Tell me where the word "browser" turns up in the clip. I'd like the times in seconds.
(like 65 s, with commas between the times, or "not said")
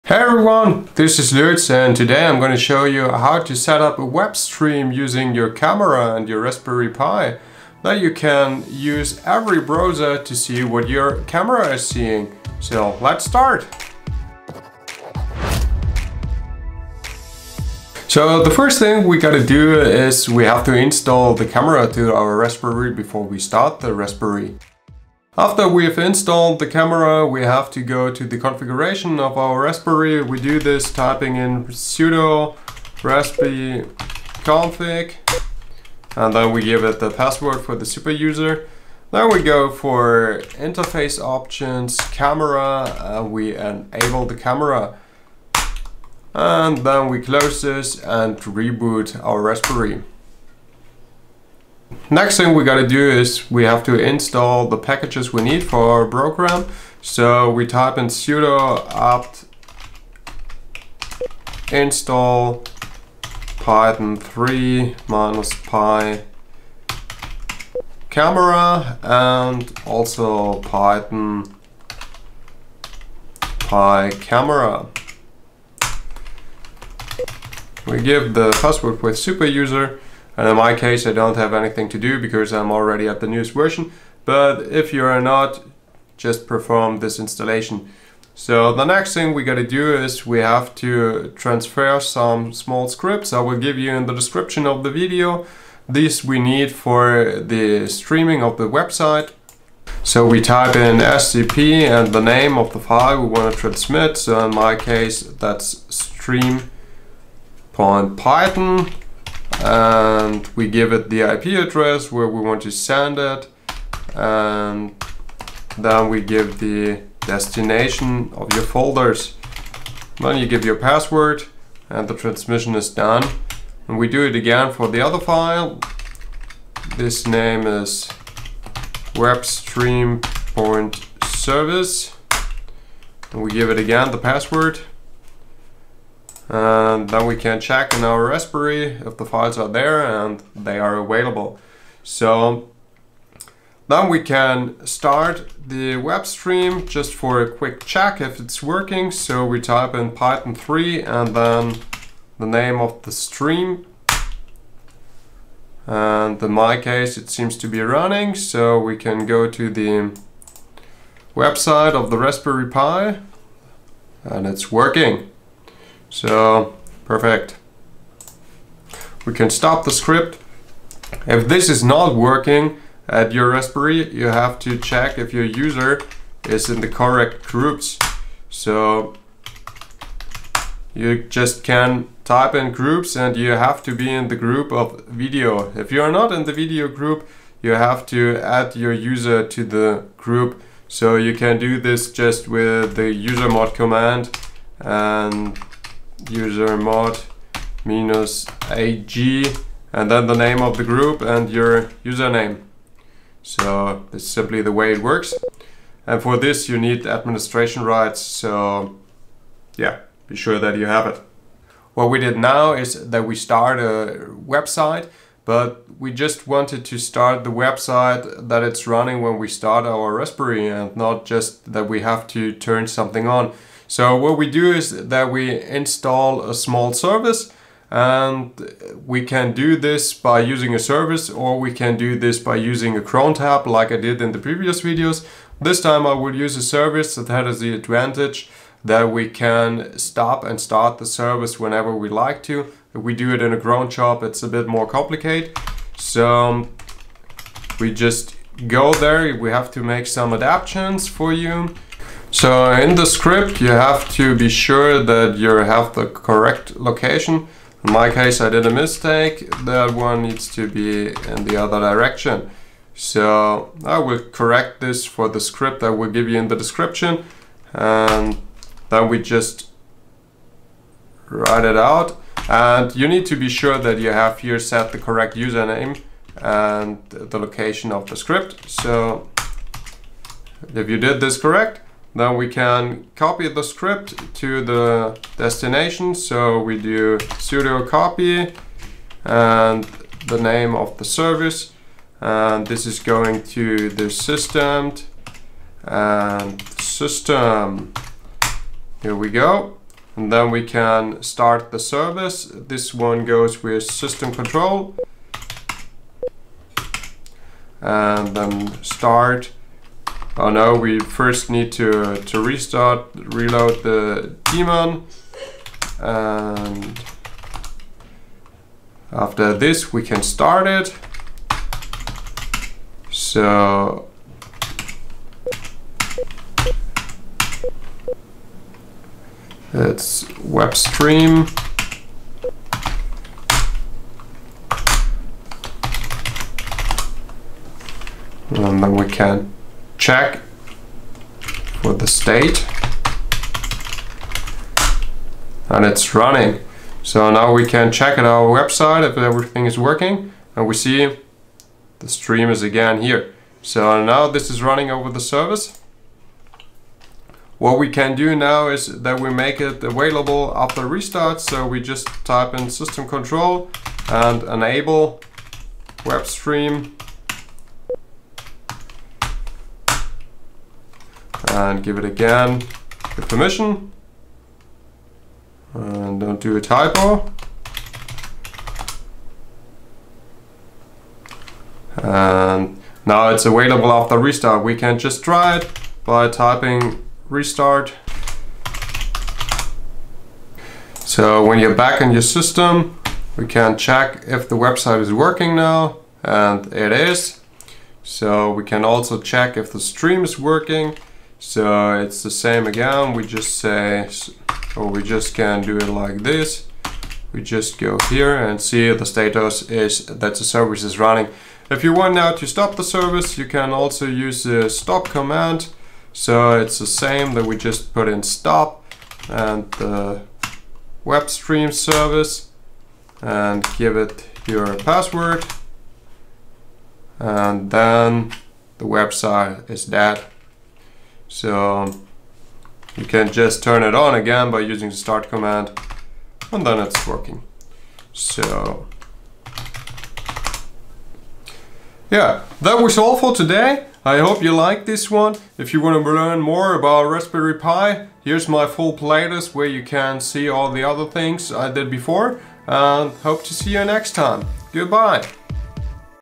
9 s.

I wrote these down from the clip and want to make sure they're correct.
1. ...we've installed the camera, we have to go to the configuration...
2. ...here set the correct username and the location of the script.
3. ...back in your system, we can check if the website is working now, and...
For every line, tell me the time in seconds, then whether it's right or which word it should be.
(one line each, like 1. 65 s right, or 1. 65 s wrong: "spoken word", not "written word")
1. 25 s right
2. 274 s right
3. 391 s right.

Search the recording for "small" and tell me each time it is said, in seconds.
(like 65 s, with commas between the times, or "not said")
92 s, 226 s.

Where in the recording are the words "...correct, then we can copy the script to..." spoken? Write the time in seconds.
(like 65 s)
281 s.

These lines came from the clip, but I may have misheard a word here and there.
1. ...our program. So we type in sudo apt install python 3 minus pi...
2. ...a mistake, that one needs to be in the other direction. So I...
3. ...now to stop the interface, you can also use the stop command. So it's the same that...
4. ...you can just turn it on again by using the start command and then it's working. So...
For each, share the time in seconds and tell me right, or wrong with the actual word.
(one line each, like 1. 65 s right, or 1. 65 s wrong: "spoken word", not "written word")
1. 55 s right
2. 258 s right
3. 412 s wrong: "service", not "interface"
4. 432 s right.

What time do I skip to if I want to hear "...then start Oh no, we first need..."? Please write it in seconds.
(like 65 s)
308 s.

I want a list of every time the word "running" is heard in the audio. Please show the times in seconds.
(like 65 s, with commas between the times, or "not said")
157 s, 218 s, 346 s, 354 s, 410 s.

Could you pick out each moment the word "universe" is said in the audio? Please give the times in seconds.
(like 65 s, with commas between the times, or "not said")
not said.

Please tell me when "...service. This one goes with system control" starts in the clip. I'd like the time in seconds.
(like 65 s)
301 s.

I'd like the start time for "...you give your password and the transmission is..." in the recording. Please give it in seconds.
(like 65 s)
120 s.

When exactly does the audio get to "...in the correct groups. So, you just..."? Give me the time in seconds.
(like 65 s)
176 s.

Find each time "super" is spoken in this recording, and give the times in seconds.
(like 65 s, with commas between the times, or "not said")
37 s, 79 s.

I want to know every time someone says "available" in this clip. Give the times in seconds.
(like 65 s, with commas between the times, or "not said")
140 s, 359 s, 383 s.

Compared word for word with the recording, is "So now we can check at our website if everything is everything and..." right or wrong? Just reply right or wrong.
wrong.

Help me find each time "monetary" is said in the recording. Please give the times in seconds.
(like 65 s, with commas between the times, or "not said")
not said.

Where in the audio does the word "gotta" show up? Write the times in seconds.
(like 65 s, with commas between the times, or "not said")
19 s, 52 s, 89 s.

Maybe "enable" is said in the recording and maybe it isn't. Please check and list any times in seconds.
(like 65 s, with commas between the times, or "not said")
43 s, 364 s.